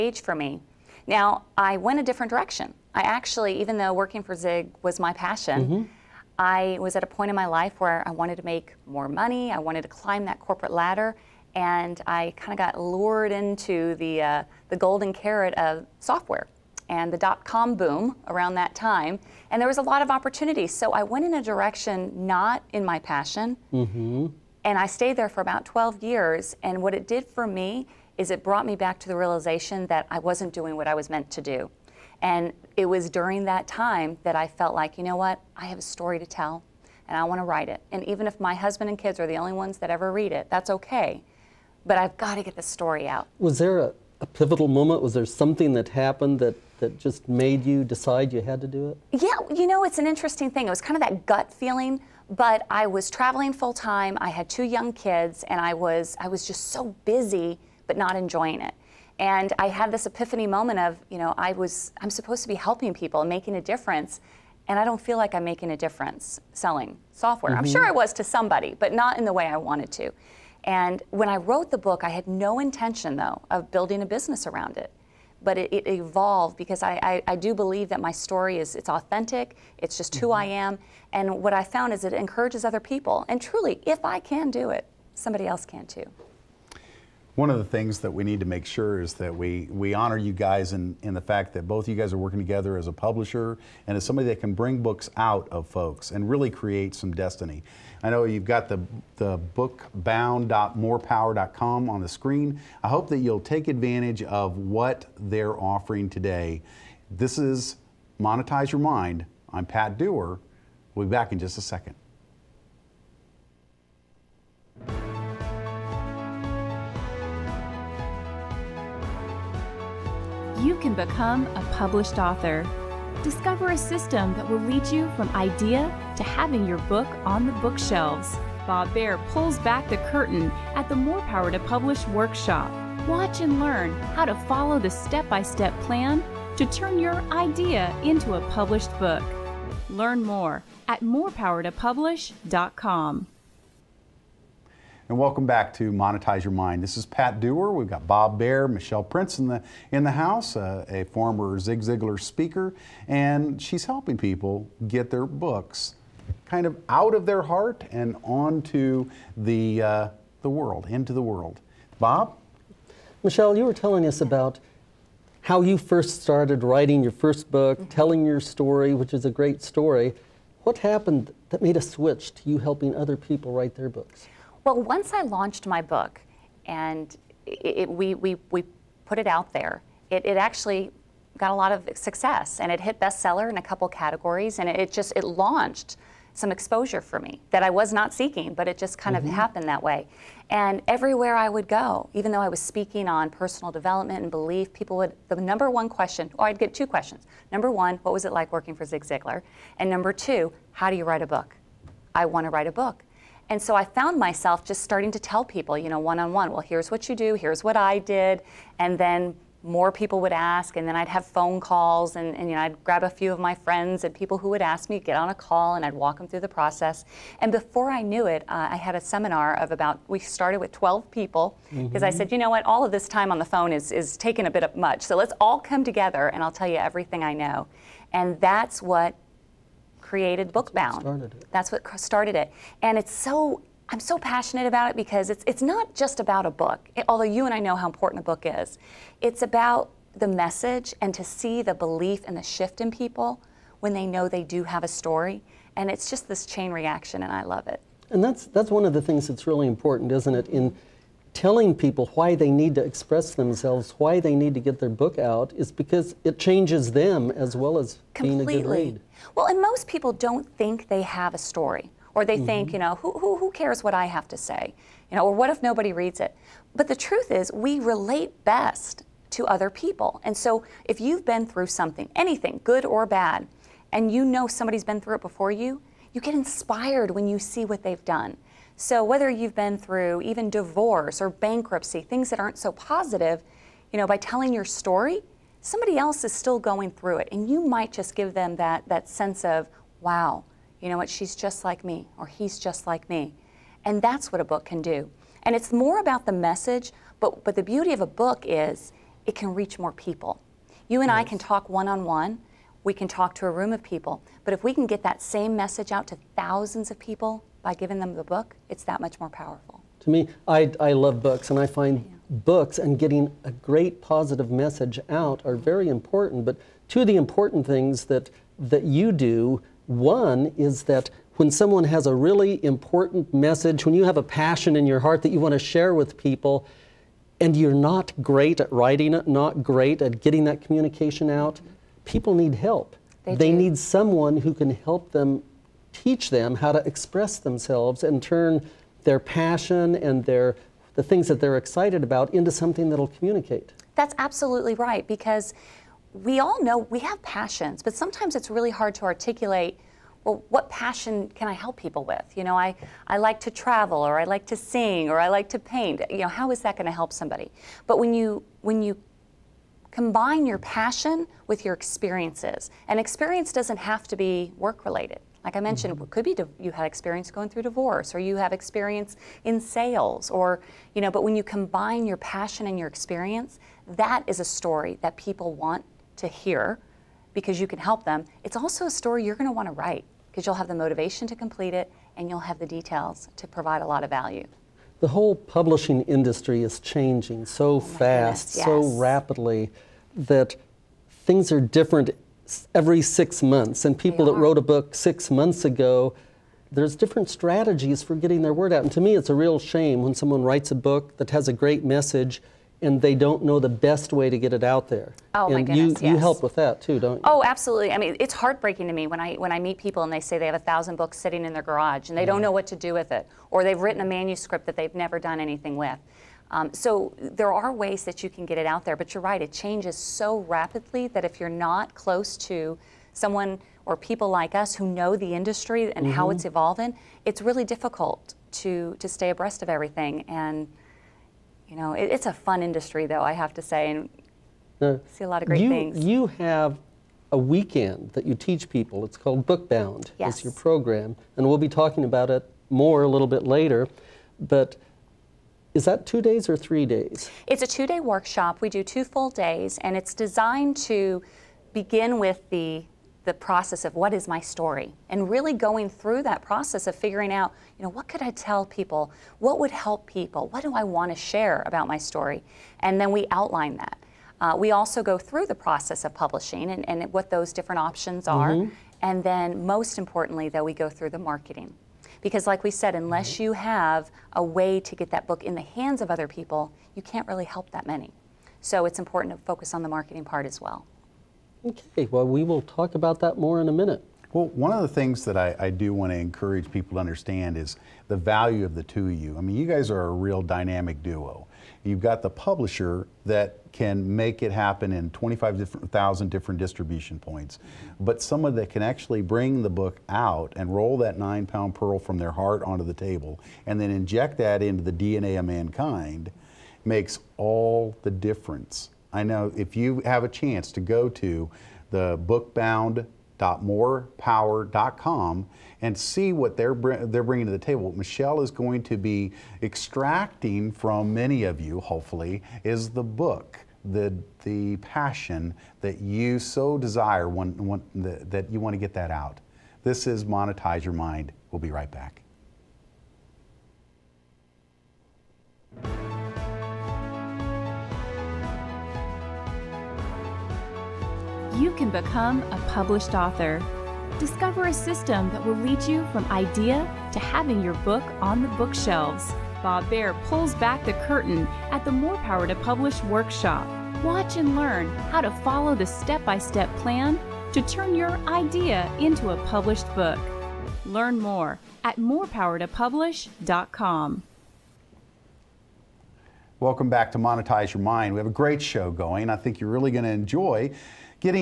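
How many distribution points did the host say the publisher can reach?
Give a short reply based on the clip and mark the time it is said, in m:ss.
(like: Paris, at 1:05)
25,000, at 8:15.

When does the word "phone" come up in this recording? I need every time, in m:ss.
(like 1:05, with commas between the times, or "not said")
3:31, 3:43.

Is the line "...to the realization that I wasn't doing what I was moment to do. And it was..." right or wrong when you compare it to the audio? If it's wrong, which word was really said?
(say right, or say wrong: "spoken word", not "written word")
wrong: "meant", not "moment".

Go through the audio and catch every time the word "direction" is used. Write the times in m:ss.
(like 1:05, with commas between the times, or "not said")
0:02, 0:21.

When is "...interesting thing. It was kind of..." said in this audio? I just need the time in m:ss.
0:50.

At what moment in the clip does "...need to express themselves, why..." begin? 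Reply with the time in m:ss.
4:12.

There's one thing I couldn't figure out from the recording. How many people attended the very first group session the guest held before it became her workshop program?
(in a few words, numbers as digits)
12.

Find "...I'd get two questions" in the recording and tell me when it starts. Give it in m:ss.
3:16.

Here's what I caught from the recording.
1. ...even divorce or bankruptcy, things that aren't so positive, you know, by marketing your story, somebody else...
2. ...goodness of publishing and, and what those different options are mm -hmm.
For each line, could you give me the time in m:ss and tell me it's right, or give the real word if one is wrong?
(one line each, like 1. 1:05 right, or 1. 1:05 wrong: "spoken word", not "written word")
1. 4:40 wrong: "telling", not "marketing"
2. 7:45 wrong: "process", not "goodness".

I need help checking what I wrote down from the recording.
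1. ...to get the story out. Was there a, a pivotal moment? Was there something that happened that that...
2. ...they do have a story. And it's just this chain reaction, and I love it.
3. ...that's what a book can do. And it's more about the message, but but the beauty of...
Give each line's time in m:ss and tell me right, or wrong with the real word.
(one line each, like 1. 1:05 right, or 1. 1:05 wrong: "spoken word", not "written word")
1. 0:42 right
2. 4:04 right
3. 4:53 right.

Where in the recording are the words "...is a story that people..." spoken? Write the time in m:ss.
6:14.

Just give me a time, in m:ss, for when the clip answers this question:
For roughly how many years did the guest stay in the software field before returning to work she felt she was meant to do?
0:25.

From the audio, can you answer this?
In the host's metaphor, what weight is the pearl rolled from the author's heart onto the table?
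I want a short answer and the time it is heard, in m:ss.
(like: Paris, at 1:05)
9 pounds, at 8:21.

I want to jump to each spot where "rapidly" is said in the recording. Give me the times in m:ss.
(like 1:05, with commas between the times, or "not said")
6:29, 7:00.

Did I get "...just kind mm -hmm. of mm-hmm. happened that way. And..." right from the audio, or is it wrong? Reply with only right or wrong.
right.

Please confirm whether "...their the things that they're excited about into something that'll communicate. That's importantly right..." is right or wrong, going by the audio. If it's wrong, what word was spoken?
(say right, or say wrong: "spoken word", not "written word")
wrong: "absolutely", not "importantly".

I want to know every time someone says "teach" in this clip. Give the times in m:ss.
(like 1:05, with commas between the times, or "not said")
5:35, 7:18.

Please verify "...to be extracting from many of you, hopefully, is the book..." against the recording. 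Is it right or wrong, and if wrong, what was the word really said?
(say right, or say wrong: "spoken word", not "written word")
right.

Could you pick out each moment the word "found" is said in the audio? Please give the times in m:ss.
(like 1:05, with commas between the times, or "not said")
1:21, 3:23.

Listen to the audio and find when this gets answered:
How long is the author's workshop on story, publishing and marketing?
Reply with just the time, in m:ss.
7:27.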